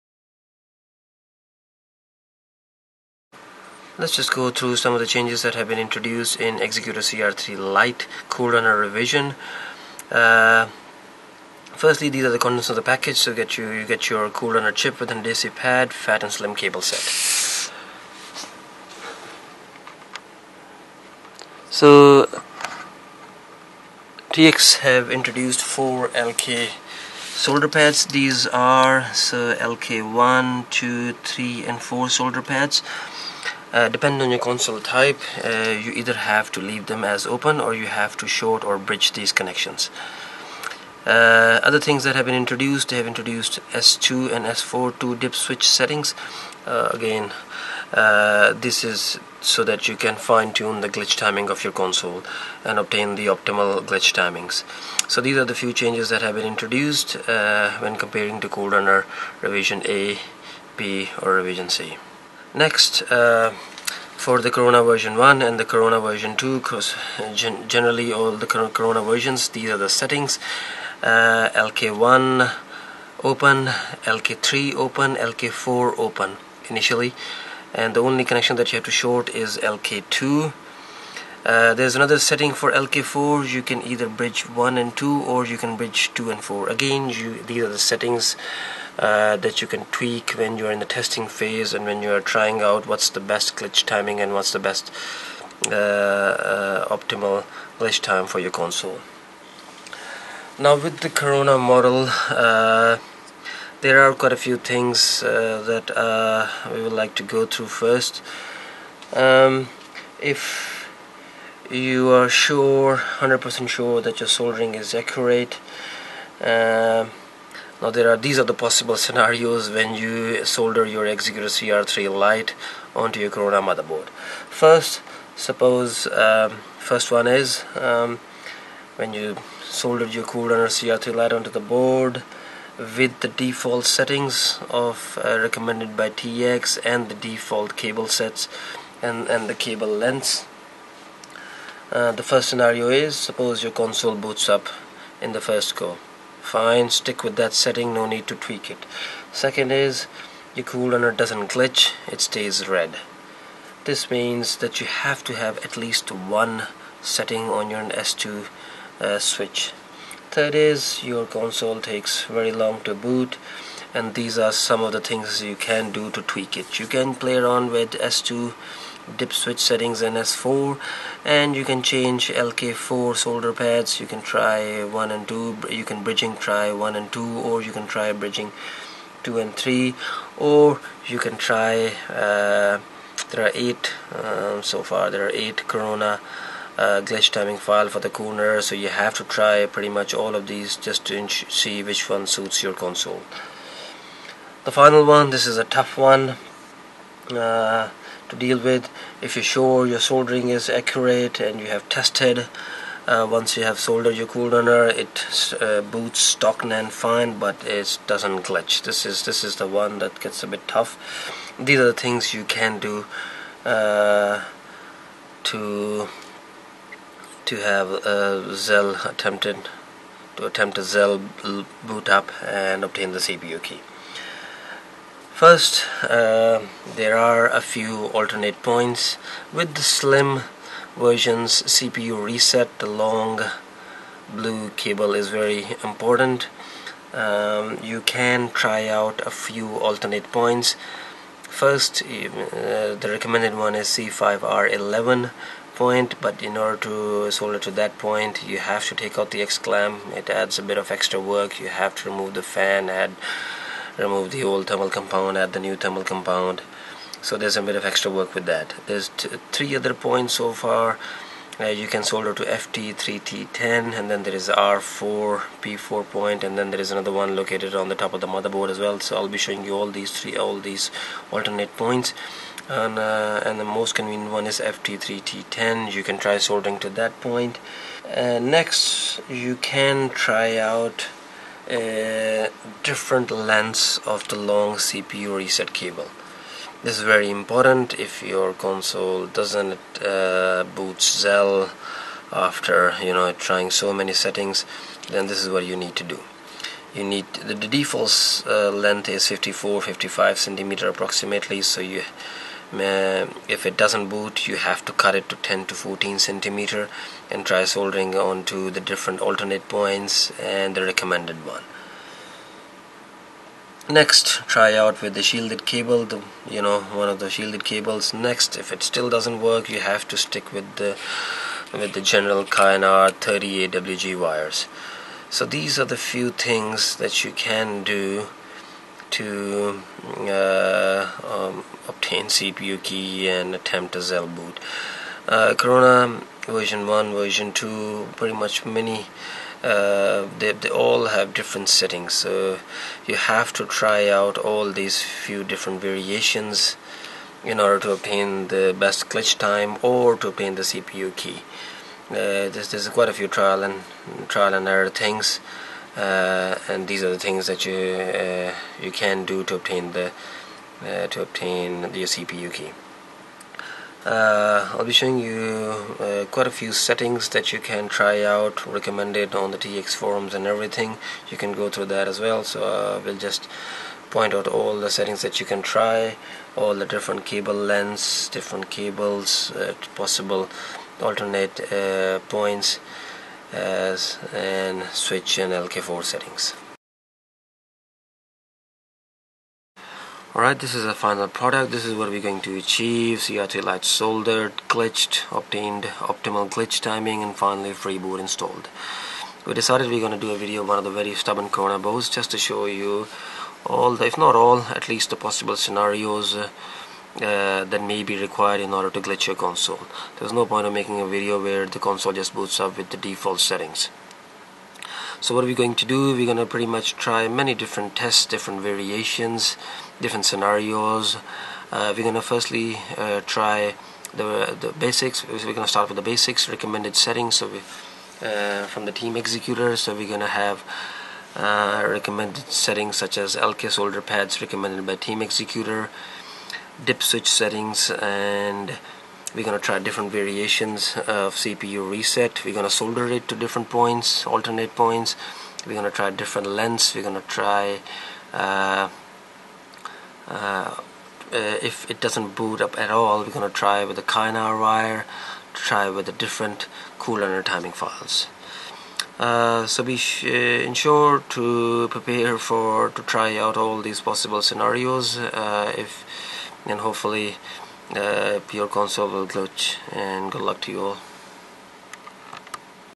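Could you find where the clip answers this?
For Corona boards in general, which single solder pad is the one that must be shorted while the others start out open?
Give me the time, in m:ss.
1:19.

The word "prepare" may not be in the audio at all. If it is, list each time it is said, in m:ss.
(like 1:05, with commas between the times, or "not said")
7:41.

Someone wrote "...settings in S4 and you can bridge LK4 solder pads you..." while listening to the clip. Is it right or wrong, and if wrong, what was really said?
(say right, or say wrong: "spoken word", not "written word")
wrong: "change", not "bridge".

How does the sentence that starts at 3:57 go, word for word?
Um, you can try out a few alternate points.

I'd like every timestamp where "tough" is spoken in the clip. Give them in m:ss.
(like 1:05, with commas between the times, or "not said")
3:15, 3:30.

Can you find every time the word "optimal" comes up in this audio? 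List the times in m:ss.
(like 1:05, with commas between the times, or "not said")
0:53, 1:36, 6:35.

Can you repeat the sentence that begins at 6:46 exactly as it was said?
Uh, uh, that may be required in order to glitch your console.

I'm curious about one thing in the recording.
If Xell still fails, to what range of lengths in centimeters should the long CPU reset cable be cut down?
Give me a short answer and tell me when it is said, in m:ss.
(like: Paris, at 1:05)
10 to 14, at 5:05.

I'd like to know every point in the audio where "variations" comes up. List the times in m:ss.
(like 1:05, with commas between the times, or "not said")
5:45, 6:58, 7:20.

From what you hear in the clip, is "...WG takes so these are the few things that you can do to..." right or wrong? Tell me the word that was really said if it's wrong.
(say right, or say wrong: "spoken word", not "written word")
wrong: "wires", not "takes".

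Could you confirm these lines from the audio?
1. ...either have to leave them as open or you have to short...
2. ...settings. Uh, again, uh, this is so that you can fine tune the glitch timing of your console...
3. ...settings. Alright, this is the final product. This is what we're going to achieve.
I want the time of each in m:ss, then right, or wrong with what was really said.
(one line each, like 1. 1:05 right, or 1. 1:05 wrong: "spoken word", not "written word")
1. 0:35 right
2. 0:45 right
3. 6:26 right.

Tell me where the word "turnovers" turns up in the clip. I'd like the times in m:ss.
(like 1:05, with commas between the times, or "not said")
not said.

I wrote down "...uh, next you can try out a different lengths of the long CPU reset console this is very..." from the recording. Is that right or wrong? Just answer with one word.
wrong.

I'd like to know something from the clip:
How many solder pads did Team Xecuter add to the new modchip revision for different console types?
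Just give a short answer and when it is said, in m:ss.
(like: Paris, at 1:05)
4, at 0:25.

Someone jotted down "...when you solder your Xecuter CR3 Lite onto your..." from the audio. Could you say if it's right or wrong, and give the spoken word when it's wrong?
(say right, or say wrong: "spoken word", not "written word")
right.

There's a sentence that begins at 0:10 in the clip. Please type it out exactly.
Uh, firstly, these are the contents of the package.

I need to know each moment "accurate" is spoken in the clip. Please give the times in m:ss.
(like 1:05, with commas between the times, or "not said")
1:54, 3:20.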